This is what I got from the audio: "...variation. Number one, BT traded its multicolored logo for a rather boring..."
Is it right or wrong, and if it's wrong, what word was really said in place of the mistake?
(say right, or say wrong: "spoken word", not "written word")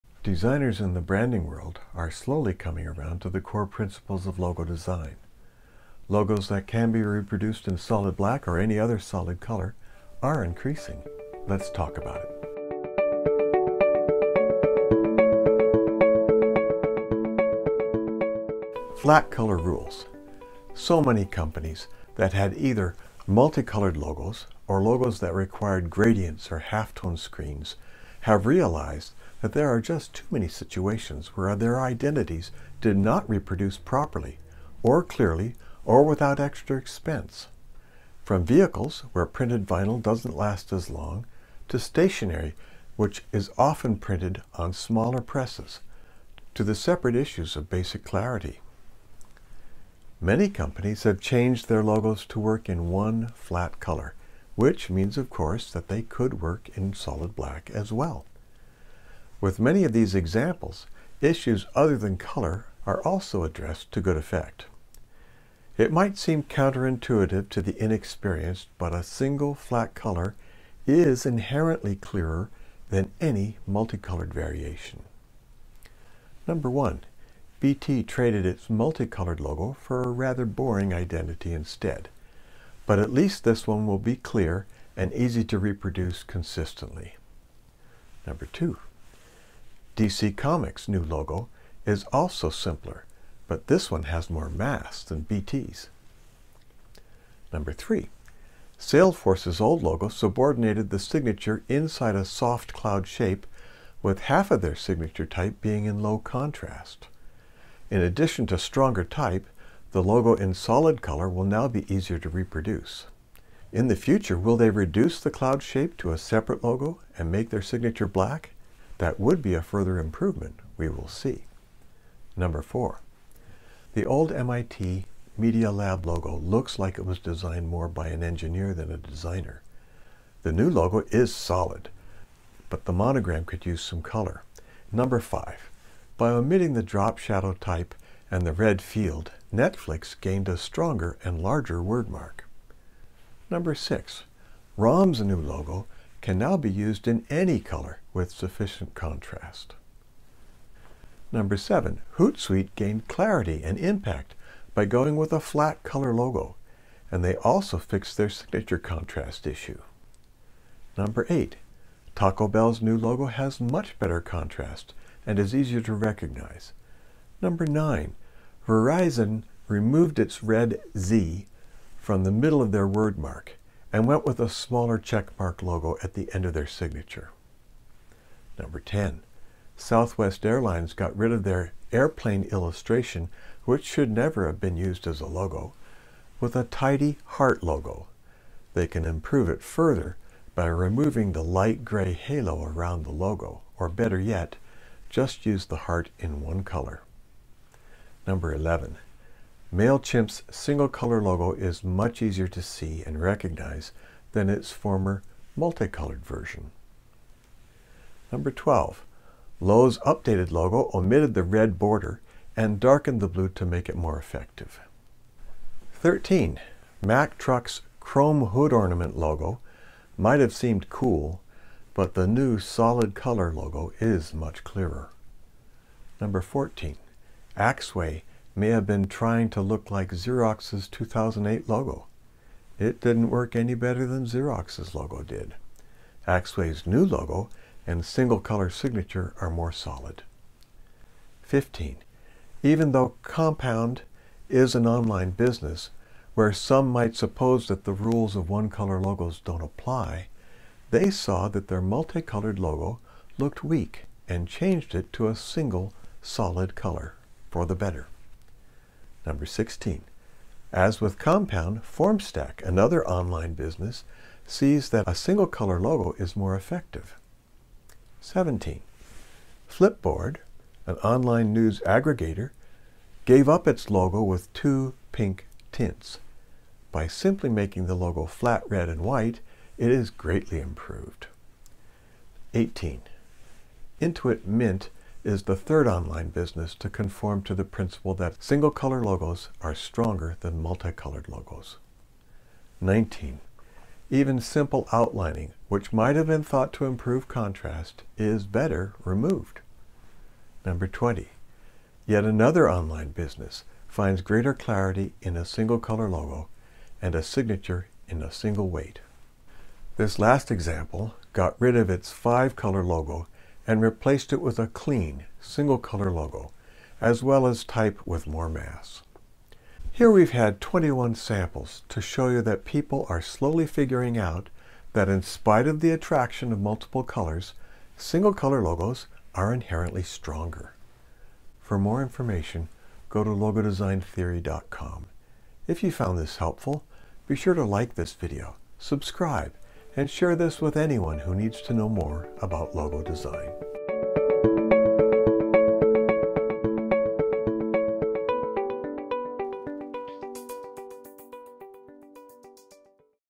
right.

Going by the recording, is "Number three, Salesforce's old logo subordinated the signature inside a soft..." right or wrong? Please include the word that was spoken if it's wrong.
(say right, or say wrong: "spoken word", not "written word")
right.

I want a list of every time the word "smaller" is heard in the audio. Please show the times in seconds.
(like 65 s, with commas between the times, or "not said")
44 s, 174 s.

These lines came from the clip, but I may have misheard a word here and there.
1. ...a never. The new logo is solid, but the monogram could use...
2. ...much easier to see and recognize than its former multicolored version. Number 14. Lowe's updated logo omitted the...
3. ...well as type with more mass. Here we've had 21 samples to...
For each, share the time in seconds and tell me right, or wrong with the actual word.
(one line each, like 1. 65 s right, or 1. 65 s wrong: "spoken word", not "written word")
1. 128 s wrong: "designer", not "never"
2. 201 s wrong: "12", not "14"
3. 317 s right.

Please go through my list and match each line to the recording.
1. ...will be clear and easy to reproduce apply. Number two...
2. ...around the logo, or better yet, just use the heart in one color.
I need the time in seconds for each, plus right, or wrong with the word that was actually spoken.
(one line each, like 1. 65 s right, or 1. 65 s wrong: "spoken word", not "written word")
1. 83 s wrong: "consistently", not "apply"
2. 192 s right.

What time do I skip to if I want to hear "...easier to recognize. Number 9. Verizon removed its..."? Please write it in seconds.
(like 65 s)
165 s.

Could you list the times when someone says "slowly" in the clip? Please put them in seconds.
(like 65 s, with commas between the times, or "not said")
2 s, 323 s.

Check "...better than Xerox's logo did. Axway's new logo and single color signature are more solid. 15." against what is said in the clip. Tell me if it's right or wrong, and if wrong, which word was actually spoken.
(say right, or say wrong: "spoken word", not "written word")
right.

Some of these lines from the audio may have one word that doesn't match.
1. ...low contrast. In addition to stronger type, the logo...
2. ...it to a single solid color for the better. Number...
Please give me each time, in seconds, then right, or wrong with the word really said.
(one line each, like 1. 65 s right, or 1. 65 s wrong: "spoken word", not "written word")
1. 106 s right
2. 254 s right.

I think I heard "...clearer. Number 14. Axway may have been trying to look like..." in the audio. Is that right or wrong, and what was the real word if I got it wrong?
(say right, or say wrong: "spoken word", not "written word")
right.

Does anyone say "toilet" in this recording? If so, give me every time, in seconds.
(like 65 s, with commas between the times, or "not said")
not said.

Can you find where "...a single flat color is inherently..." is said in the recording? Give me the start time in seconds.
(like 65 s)
68 s.